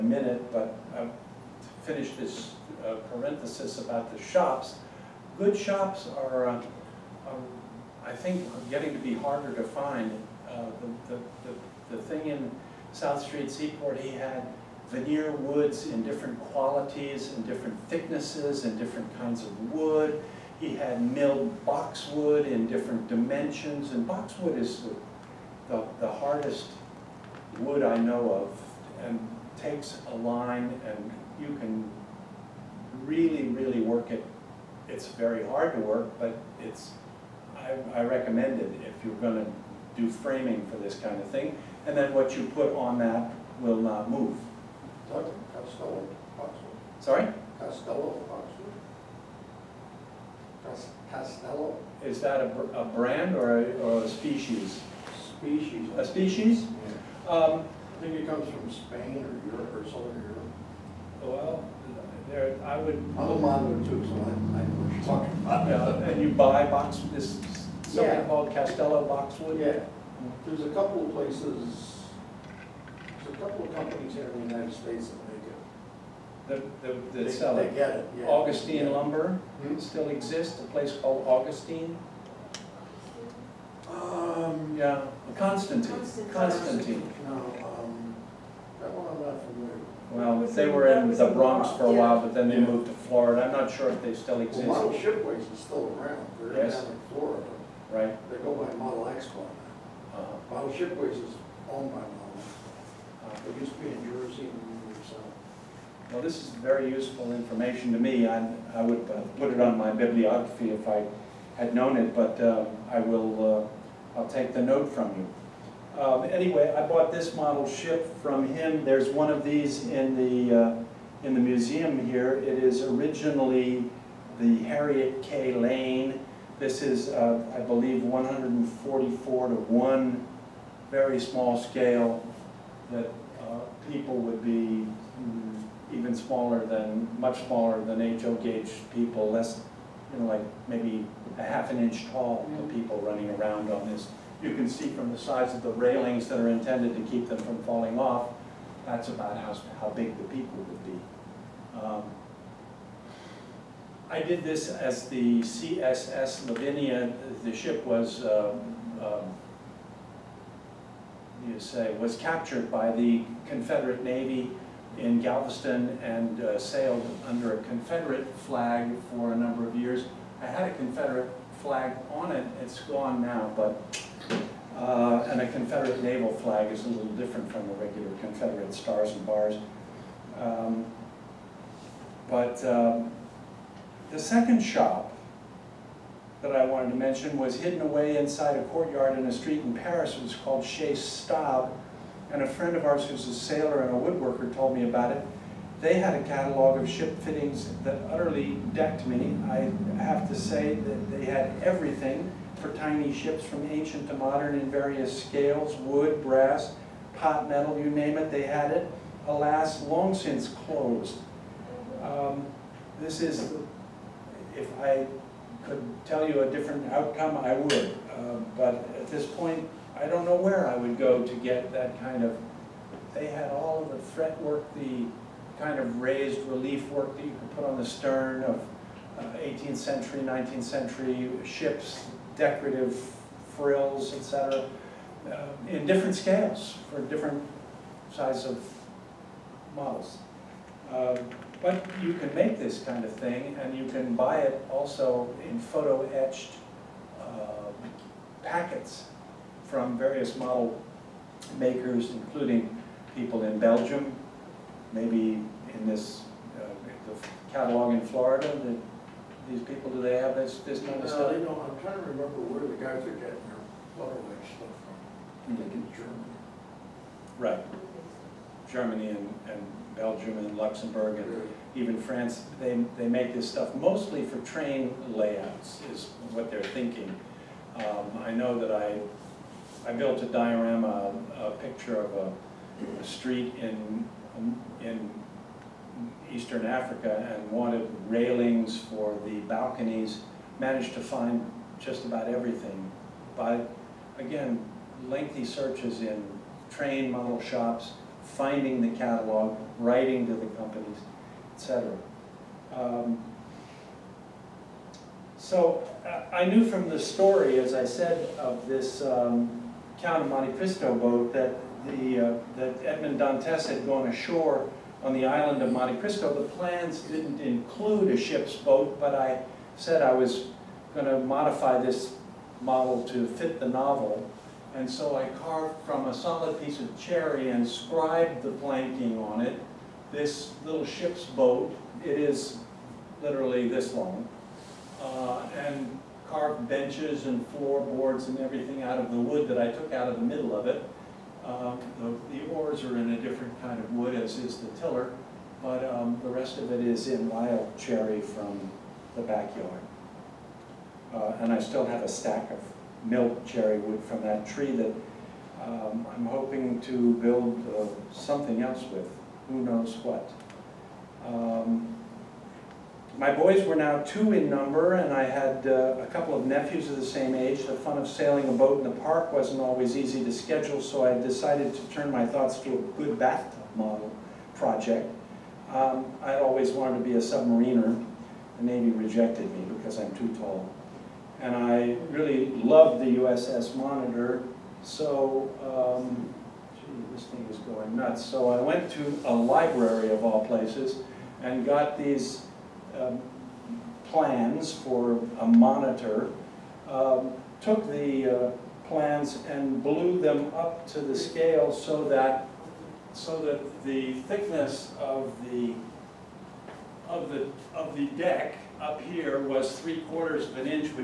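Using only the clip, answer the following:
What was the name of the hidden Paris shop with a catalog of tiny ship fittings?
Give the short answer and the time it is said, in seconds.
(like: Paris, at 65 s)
Chez Staub, at 190 s.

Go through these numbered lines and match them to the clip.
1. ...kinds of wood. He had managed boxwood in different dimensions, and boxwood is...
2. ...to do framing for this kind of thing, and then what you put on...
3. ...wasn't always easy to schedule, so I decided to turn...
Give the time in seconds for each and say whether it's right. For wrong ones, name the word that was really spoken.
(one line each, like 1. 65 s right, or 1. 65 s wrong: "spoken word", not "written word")
1. 19 s wrong: "milled", not "managed"
2. 39 s right
3. 369 s right.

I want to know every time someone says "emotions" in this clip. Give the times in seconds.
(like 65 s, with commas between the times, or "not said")
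not said.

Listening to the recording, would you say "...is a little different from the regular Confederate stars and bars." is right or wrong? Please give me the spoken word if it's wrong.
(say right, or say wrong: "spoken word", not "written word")
right.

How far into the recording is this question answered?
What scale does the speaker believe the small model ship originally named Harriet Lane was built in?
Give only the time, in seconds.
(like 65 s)
128 s.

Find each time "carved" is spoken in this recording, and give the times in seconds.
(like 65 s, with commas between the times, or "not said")
325 s, 336 s.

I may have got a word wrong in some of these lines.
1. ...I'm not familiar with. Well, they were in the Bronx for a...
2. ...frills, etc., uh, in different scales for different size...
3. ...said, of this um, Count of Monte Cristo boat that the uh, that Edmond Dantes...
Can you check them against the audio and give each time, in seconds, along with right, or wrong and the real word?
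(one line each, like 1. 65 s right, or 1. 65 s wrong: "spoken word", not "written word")
1. 89 s right
2. 233 s right
3. 307 s right.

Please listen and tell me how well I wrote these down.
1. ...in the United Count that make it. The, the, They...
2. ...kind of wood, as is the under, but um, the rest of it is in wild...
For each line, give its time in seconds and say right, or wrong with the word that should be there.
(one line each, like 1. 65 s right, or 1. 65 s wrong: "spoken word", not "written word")
1. 74 s wrong: "States", not "Count"
2. 343 s wrong: "tiller", not "under".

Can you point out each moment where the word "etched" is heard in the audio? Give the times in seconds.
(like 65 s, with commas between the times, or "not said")
245 s, 263 s.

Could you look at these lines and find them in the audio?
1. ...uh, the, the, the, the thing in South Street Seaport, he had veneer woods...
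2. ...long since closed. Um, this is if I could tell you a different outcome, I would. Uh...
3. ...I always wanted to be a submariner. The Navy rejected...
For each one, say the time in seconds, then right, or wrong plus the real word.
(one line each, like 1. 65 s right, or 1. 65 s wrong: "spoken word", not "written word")
1. 10 s right
2. 209 s right
3. 376 s right.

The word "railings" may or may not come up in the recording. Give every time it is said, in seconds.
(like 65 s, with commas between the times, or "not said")
145 s, 288 s.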